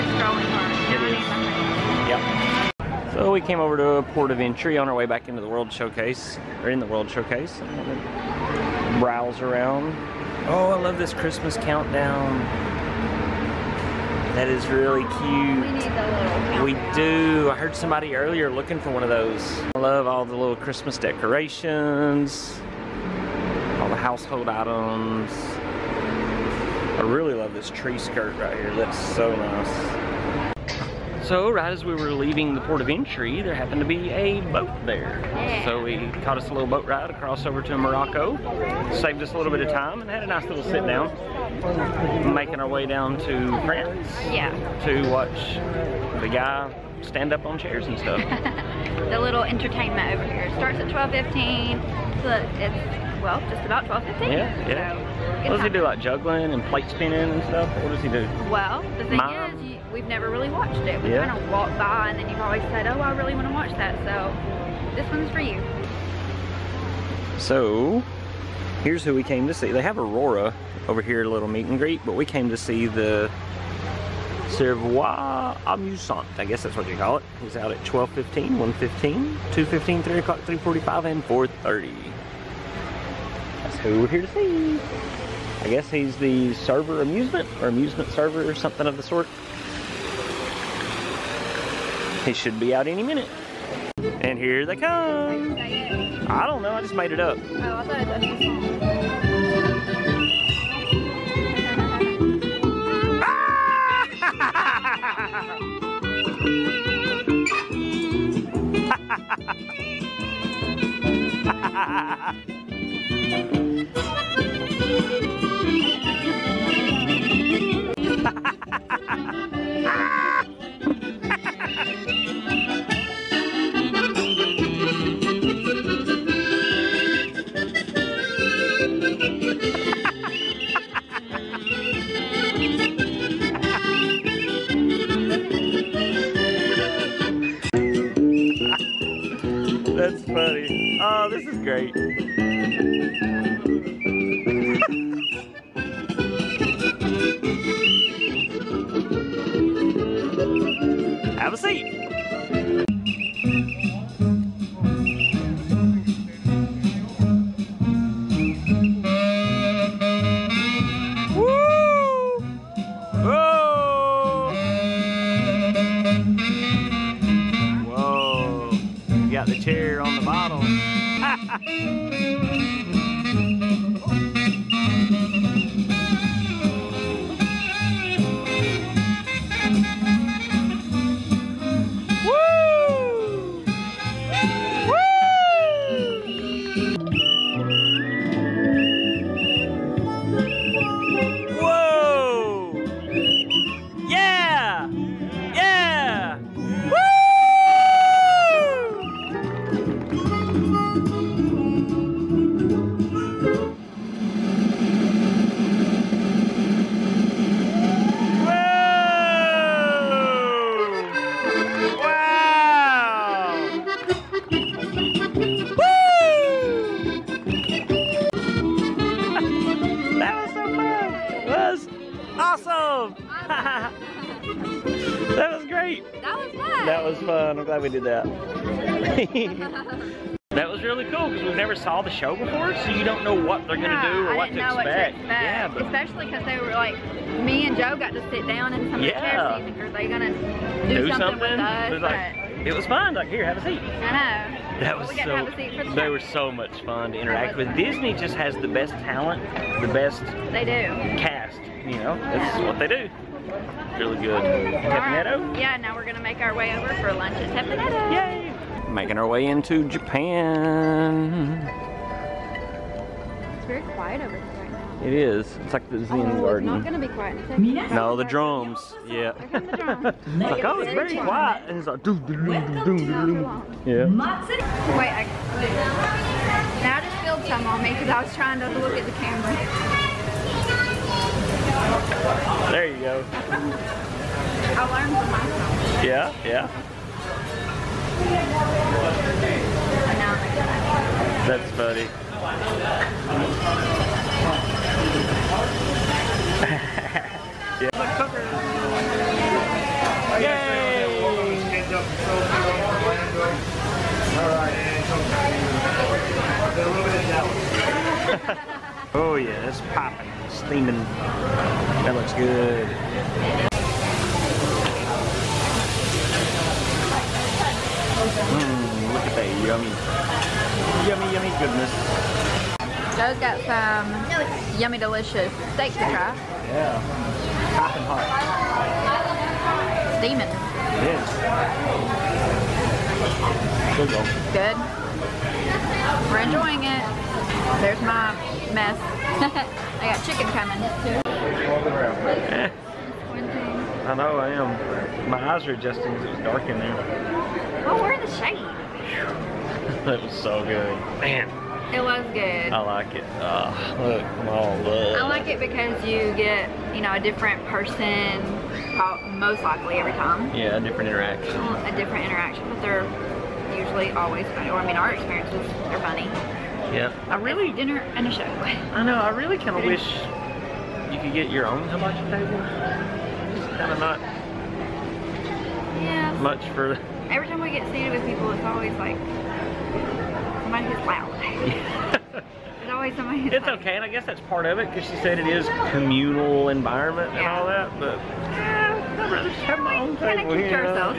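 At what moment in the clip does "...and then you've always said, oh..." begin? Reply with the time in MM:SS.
01:02.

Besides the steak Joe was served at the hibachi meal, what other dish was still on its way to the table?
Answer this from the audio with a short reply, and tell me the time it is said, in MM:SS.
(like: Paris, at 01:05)
chicken, at 05:40.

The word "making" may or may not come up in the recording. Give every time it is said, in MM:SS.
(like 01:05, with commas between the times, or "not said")
00:42, 04:18.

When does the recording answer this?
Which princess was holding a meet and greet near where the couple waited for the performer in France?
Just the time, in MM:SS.
01:09.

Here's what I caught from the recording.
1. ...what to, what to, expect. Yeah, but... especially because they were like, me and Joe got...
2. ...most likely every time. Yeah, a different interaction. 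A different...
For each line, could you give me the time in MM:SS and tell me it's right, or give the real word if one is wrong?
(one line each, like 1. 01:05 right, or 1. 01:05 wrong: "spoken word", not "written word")
1. 03:54 right
2. 05:59 right.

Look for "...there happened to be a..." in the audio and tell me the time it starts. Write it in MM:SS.
00:33.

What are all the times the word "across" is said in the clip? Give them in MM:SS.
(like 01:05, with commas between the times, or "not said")
00:37.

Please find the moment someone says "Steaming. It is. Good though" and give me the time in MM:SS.
05:30.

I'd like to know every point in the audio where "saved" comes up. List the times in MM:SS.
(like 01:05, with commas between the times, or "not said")
00:38.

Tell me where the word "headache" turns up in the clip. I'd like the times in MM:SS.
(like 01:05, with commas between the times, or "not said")
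not said.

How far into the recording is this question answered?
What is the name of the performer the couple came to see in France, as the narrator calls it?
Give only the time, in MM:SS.
01:14.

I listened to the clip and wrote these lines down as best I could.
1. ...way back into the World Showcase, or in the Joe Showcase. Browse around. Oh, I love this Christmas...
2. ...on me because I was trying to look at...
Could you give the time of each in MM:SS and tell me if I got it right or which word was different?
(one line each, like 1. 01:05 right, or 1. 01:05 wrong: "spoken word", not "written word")
1. 00:04 wrong: "World", not "Joe"
2. 04:37 right.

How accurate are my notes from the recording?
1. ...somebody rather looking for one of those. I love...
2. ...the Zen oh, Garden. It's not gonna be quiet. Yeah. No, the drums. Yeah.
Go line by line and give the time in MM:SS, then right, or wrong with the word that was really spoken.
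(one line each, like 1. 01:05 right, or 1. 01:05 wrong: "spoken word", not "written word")
1. 00:17 wrong: "earlier", not "rather"
2. 04:25 right.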